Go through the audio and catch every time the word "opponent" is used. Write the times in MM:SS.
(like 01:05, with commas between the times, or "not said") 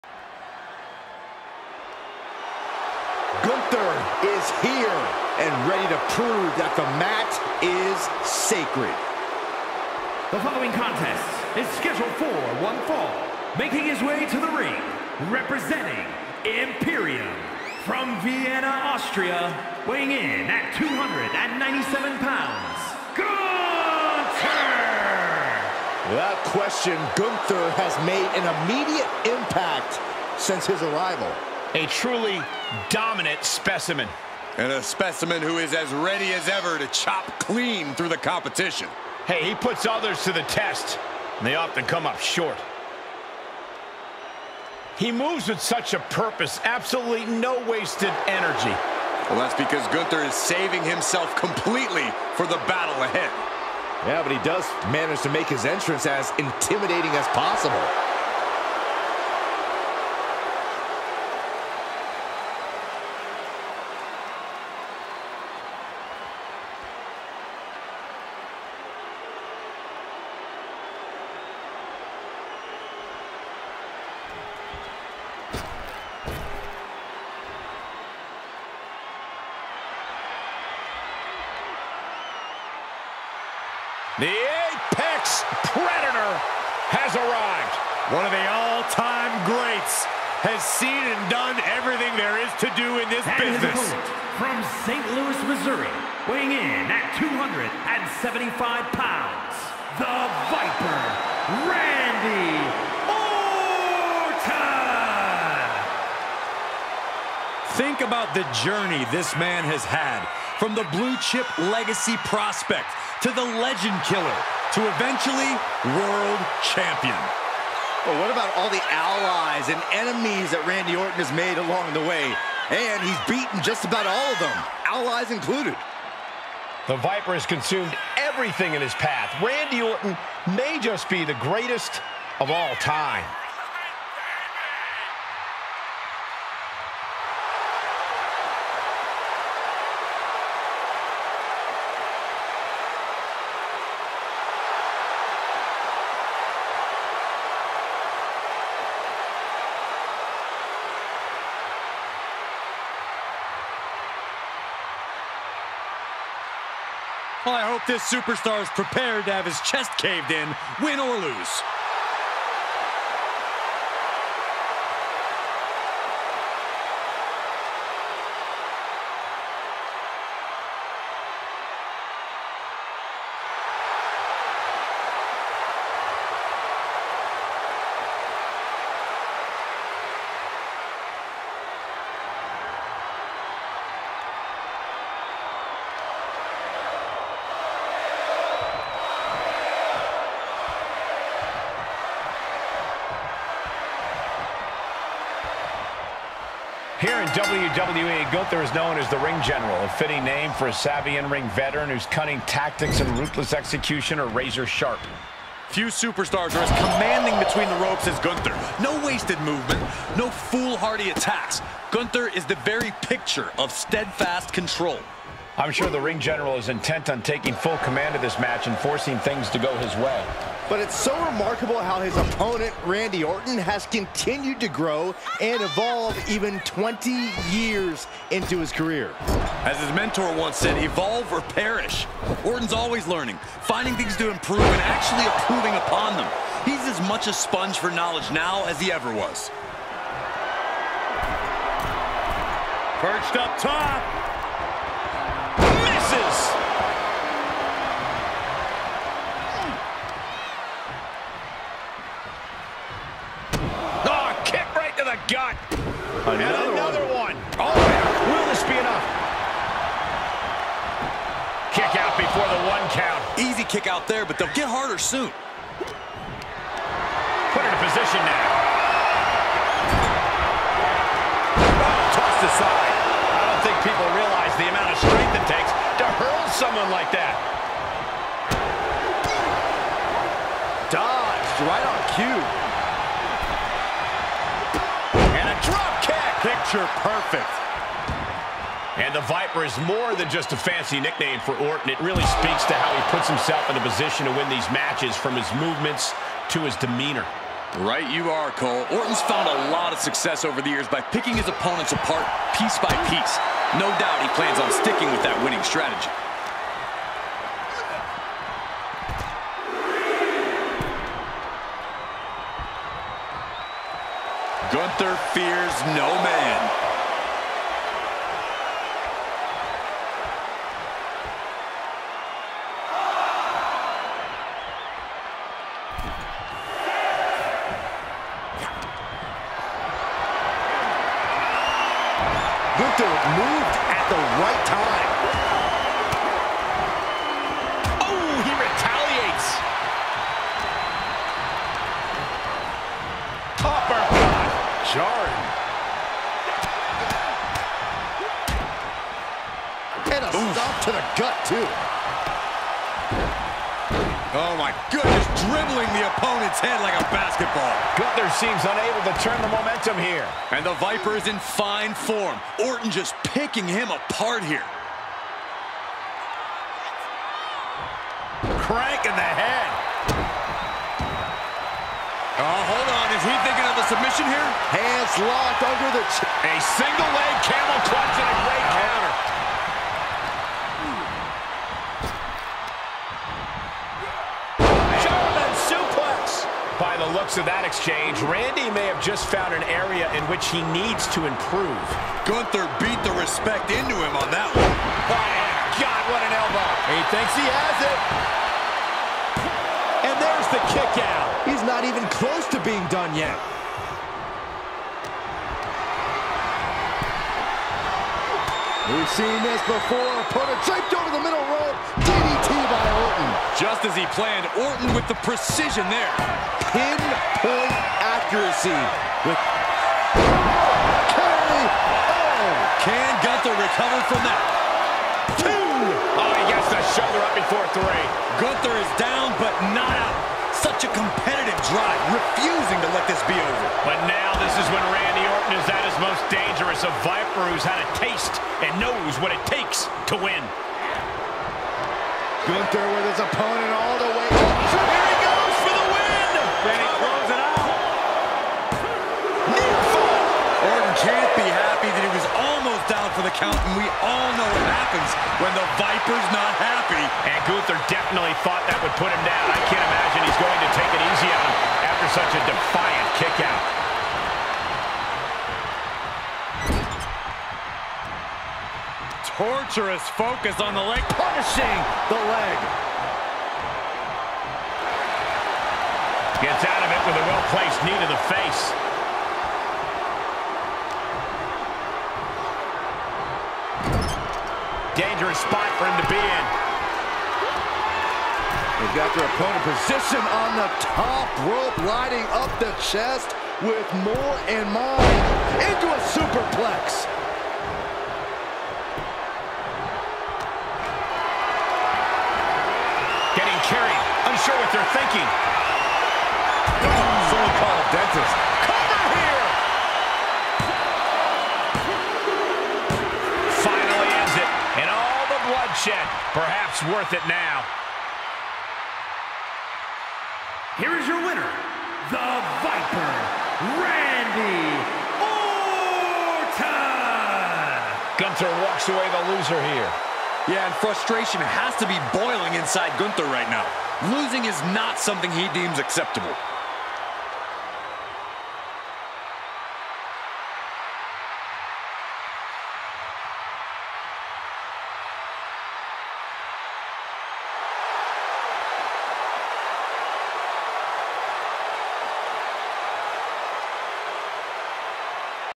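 03:42, 05:01, 05:56, 07:23, 08:09.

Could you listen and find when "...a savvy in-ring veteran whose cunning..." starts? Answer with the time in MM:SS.
03:20.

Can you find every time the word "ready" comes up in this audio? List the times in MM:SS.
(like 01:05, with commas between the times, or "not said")
00:05, 00:35.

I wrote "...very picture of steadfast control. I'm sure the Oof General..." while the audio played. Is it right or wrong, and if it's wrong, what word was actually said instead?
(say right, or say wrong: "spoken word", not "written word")
wrong: "Ring", not "Oof".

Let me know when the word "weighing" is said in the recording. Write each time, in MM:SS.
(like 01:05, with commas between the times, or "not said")
00:19, 01:36.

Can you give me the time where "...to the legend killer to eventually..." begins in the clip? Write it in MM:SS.
01:53.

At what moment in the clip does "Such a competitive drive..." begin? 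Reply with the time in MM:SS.
07:10.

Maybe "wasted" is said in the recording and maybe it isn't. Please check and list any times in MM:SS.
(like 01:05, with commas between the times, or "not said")
00:47, 03:29.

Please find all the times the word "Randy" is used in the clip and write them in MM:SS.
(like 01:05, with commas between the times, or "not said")
01:41, 02:00, 02:09, 03:42, 06:28, 07:14, 08:43.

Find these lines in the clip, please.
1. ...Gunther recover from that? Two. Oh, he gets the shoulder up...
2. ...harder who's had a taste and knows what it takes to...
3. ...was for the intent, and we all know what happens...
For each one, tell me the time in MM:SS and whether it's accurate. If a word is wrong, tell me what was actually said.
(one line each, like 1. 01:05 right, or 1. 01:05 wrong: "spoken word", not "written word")
1. 07:03 right
2. 07:17 wrong: "viper", not "harder"
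3. 07:32 wrong: "count", not "intent".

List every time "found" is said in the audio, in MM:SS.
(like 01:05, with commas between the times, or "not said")
04:59, 06:29.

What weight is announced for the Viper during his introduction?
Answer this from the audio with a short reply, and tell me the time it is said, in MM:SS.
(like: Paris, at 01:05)
275 pounds, at 01:37.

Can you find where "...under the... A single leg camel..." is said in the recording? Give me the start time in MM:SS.
06:15.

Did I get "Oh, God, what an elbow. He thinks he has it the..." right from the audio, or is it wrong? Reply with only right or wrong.
right.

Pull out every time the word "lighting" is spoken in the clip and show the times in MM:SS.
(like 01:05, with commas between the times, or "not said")
08:11.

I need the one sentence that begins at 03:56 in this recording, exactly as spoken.
He's as much a sponge for knowledge now as he ever was.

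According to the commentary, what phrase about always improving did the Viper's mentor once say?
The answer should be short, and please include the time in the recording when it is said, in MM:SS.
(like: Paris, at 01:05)
Evolve or perish, at 03:50.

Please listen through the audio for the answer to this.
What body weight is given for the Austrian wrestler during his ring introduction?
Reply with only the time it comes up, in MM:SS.
00:20.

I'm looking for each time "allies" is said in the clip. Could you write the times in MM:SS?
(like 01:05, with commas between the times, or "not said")
01:58, 02:04.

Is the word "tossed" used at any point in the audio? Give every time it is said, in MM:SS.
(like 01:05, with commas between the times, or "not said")
04:32.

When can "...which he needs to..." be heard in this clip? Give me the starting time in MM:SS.
06:30.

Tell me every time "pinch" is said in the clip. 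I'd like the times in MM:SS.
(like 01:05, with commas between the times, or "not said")
not said.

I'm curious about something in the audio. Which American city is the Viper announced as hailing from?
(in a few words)
St. Louis, Missouri.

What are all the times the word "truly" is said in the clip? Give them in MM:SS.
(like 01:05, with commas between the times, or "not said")
00:31.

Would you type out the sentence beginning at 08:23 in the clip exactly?
Getting carried, unsure what they're thinking.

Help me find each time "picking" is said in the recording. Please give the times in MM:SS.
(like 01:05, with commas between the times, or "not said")
05:01, 06:03.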